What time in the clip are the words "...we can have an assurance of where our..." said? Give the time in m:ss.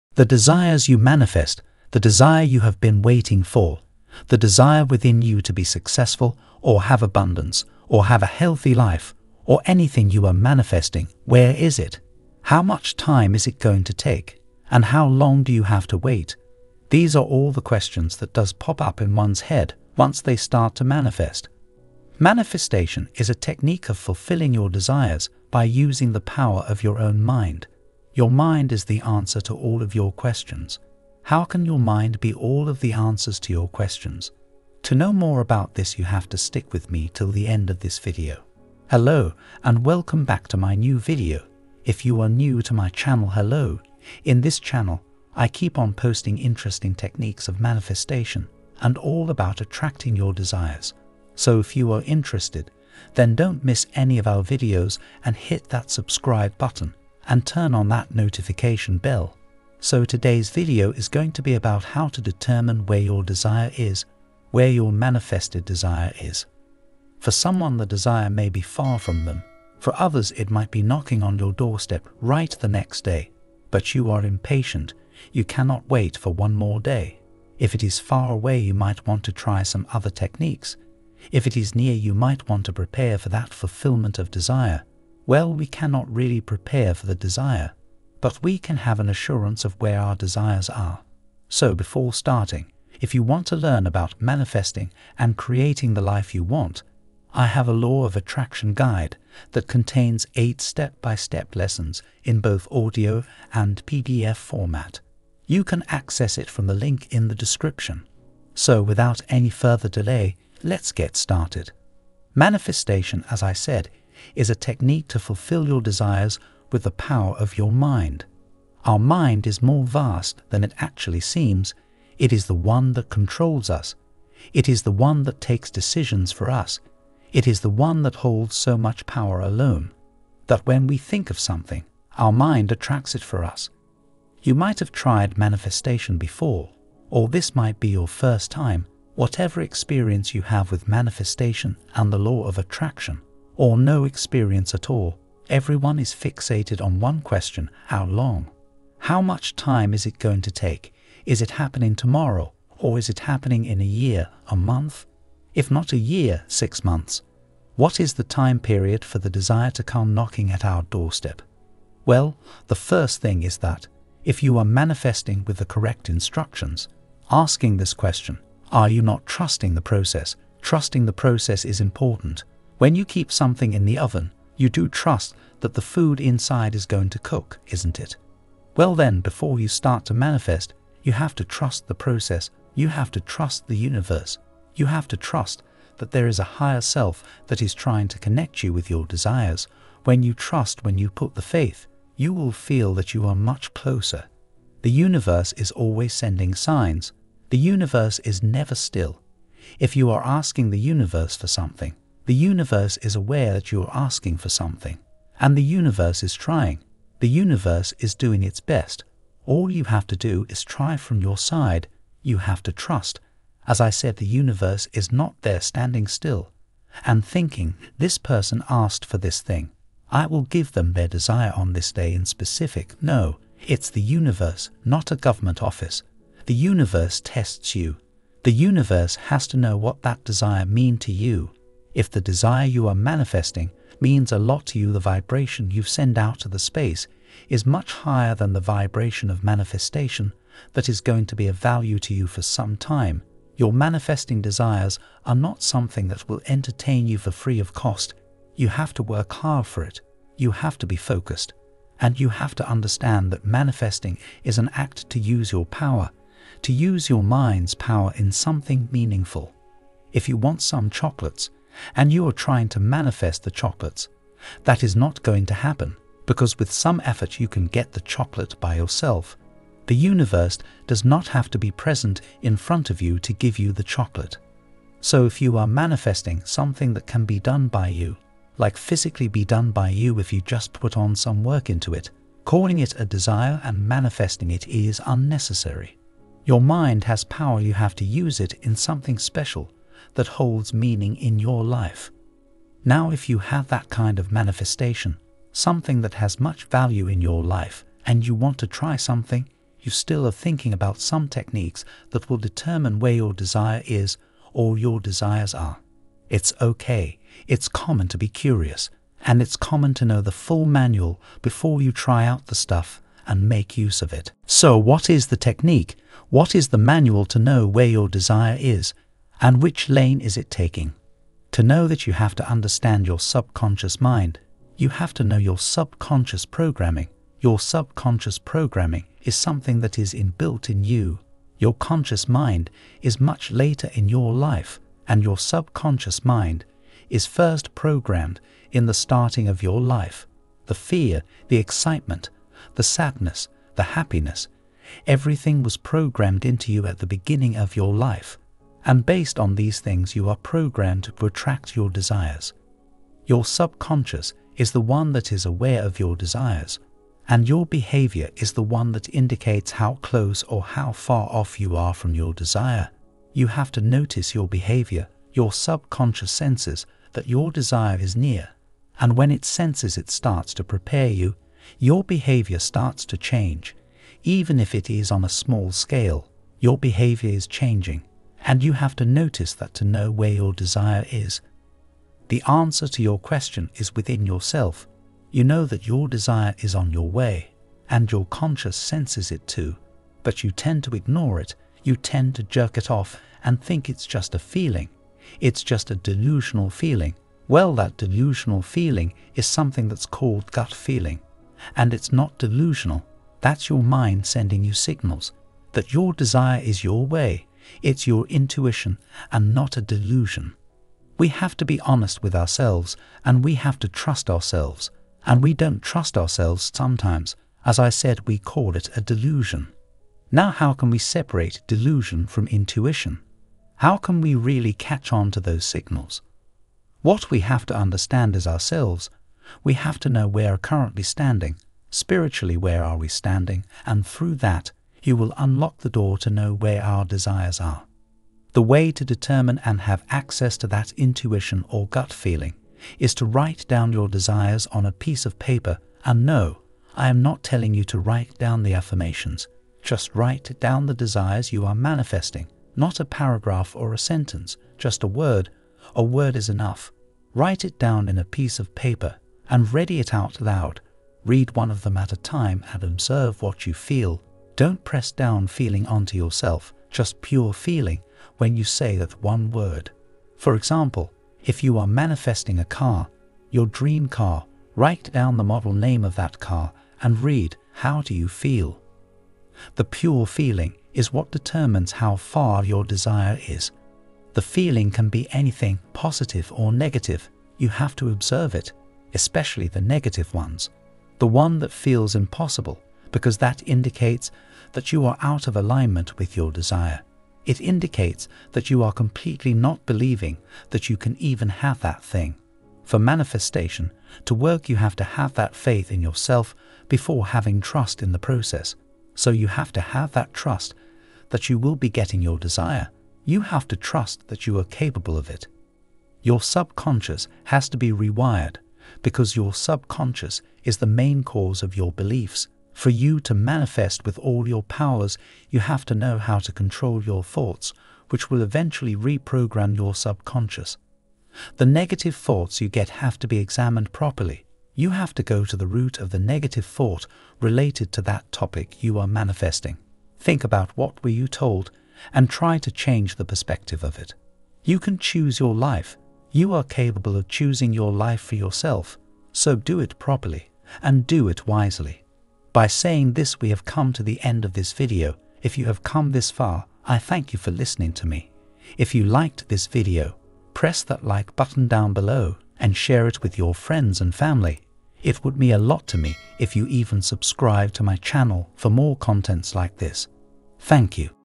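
1:28.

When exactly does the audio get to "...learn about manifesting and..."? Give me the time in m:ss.
1:33.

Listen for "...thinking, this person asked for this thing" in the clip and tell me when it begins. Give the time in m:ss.
3:37.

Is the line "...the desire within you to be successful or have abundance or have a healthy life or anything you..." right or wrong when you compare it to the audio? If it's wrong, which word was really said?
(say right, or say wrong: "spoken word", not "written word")
right.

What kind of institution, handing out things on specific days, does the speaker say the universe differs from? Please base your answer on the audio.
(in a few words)
A government office.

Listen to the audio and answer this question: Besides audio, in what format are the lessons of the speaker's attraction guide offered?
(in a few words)
PDF.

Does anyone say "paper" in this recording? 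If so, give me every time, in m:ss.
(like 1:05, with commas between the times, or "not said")
7:25, 7:38.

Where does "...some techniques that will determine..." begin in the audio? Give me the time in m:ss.
5:00.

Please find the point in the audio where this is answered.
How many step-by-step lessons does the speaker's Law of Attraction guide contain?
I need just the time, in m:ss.
1:40.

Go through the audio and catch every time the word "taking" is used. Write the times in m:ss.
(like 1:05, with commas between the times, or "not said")
5:20.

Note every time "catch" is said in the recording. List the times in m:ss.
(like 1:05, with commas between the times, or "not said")
7:04.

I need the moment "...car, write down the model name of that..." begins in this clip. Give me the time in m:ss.
7:54.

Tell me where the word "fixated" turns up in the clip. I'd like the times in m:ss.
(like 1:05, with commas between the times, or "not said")
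2:26.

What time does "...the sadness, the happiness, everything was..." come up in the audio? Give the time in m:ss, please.
5:42.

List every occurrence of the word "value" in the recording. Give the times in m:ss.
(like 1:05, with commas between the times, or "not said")
4:01, 4:56.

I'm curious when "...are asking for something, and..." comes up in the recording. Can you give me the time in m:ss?
3:23.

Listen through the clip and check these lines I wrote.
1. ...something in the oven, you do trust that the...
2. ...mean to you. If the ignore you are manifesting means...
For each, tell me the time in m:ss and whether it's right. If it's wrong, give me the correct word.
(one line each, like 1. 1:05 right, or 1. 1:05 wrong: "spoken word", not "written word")
1. 2:53 right
2. 3:50 wrong: "desire", not "ignore".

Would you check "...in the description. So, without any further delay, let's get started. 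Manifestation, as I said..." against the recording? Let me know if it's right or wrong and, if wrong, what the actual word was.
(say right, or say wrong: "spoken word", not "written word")
right.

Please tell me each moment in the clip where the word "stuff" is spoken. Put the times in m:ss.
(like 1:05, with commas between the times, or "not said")
5:12.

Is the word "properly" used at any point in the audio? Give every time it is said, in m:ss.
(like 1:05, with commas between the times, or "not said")
8:53, 9:09.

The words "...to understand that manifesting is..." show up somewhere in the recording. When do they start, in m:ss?
4:12.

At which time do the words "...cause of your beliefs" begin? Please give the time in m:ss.
8:41.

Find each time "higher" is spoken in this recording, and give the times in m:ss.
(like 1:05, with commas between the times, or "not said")
3:06, 3:57.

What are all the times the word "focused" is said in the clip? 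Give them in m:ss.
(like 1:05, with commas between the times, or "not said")
4:10.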